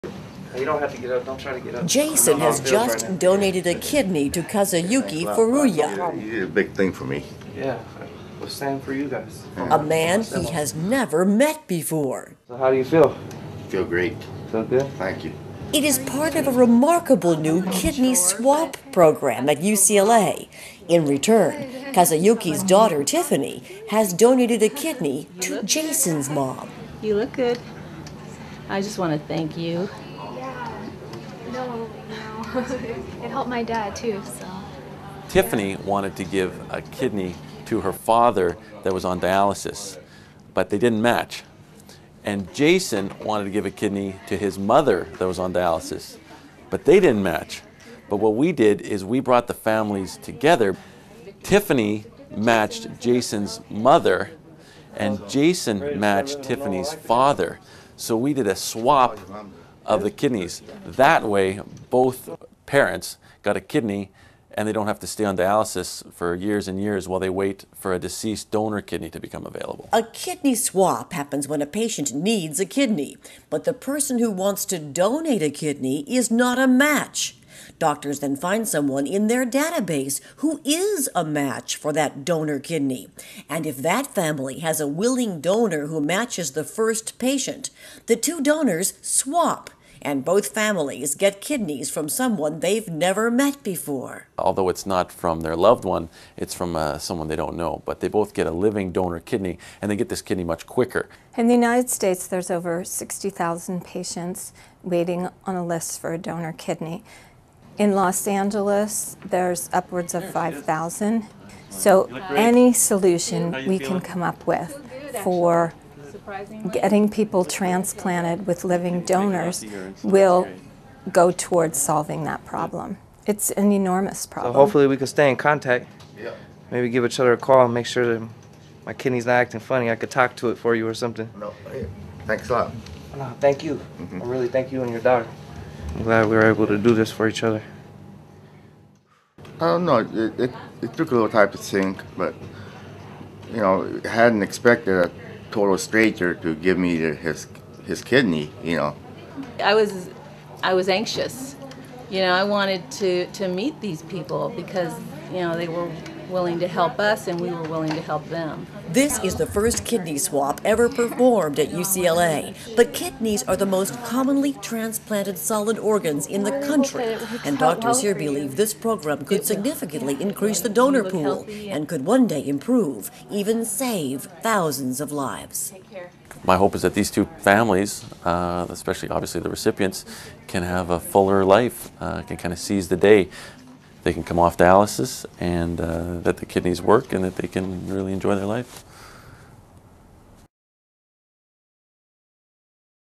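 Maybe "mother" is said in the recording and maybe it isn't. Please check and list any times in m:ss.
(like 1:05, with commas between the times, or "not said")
0:44, 0:53.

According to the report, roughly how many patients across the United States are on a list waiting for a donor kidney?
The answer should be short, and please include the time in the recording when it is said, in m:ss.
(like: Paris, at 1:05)
60,000, at 1:42.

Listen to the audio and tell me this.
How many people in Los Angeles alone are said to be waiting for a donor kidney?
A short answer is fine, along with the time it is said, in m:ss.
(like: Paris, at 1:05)
5,000, at 1:50.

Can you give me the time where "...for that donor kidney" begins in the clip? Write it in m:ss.
1:21.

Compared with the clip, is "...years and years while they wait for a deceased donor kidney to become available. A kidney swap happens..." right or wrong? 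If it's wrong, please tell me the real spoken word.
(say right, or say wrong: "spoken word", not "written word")
right.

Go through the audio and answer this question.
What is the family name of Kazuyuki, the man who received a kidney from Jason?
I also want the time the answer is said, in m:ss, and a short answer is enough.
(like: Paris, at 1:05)
Furuya, at 0:05.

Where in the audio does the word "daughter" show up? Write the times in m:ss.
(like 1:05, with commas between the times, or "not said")
0:22, 2:15.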